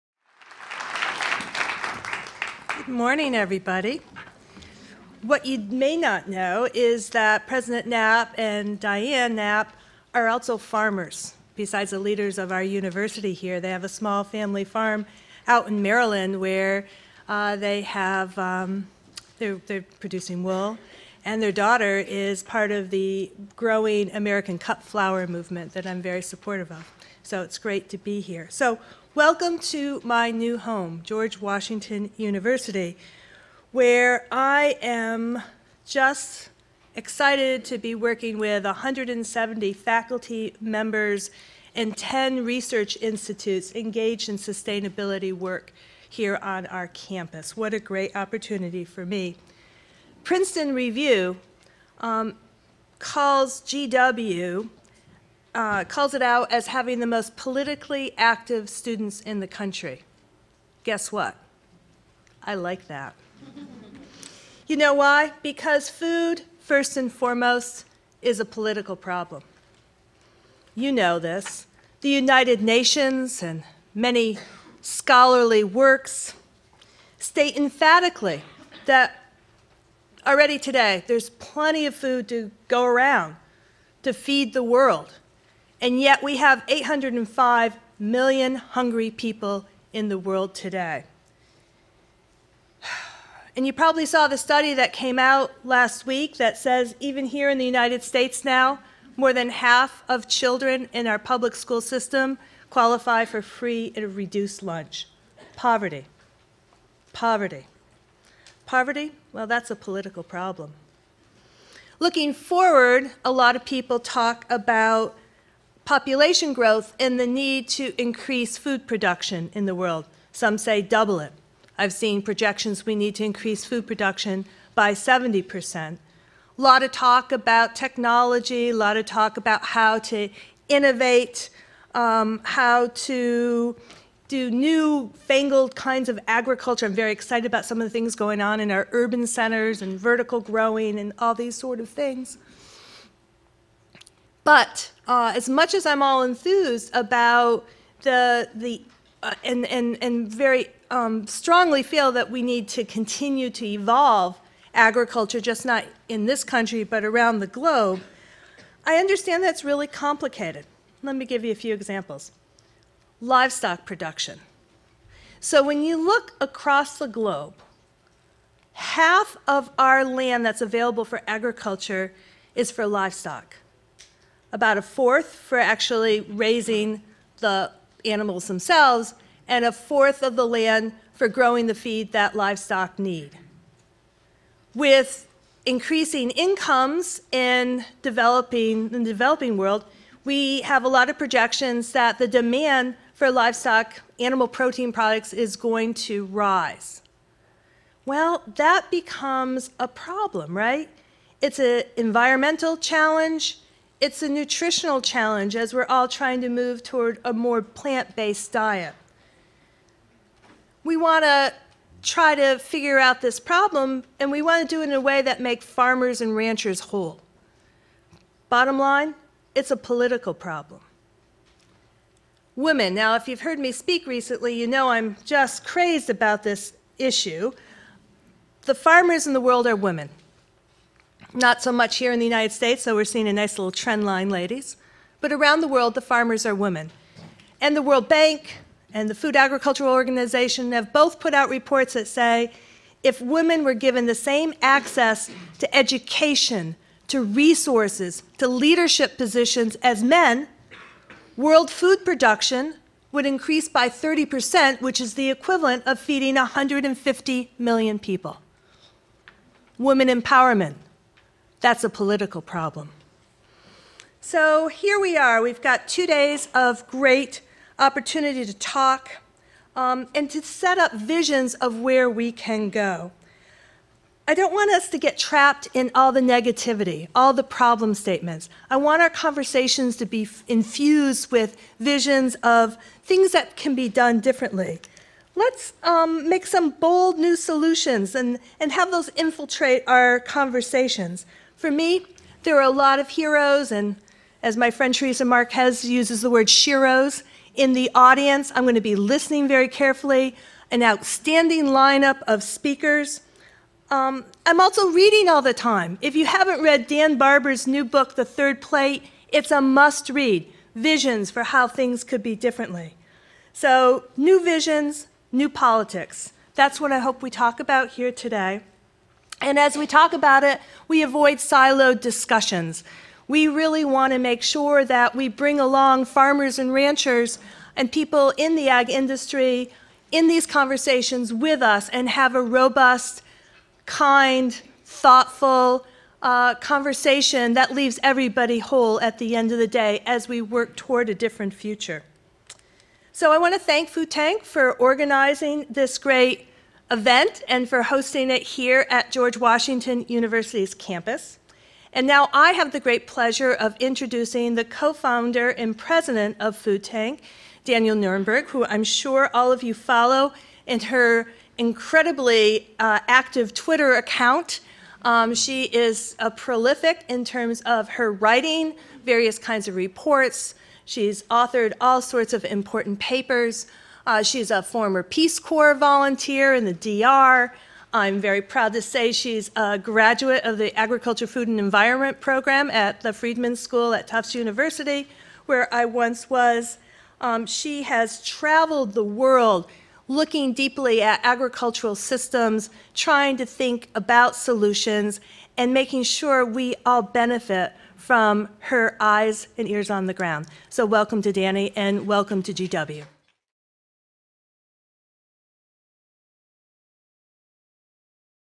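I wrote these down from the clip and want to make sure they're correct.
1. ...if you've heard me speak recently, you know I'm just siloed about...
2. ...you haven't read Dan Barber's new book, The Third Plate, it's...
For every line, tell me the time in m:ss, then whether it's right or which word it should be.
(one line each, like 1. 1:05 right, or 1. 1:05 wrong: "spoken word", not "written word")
1. 3:43 wrong: "crazed", not "siloed"
2. 5:06 right.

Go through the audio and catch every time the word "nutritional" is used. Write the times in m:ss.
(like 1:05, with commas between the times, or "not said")
3:24.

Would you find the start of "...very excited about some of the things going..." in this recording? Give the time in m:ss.
2:16.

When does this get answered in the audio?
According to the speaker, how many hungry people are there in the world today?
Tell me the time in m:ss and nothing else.
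1:26.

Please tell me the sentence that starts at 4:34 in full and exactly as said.
I don't want us to get trapped in all the negativity, all the problem statements.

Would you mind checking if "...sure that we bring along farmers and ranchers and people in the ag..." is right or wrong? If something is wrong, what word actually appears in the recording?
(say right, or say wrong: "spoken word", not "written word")
right.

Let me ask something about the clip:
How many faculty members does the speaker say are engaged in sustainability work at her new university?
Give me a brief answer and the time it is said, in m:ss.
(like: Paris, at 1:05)
170, at 0:38.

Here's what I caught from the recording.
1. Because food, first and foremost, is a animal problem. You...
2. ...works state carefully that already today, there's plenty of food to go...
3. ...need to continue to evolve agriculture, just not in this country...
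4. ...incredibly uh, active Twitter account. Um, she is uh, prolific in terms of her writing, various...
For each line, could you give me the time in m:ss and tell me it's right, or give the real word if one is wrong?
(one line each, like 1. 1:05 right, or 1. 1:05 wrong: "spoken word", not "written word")
1. 1:05 wrong: "political", not "animal"
2. 1:15 wrong: "emphatically", not "carefully"
3. 2:32 right
4. 6:01 right.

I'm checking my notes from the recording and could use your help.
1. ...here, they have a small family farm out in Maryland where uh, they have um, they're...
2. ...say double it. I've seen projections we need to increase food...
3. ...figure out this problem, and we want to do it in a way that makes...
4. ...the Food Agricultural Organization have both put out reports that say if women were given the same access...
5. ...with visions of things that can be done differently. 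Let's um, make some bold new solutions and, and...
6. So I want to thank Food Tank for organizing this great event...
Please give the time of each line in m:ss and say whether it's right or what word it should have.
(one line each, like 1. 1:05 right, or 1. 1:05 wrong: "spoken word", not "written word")
1. 0:13 right
2. 2:00 right
3. 3:32 right
4. 3:59 right
5. 4:41 right
6. 5:43 right.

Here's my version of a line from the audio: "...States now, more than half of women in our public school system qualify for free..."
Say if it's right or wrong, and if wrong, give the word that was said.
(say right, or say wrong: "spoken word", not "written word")
wrong: "children", not "women".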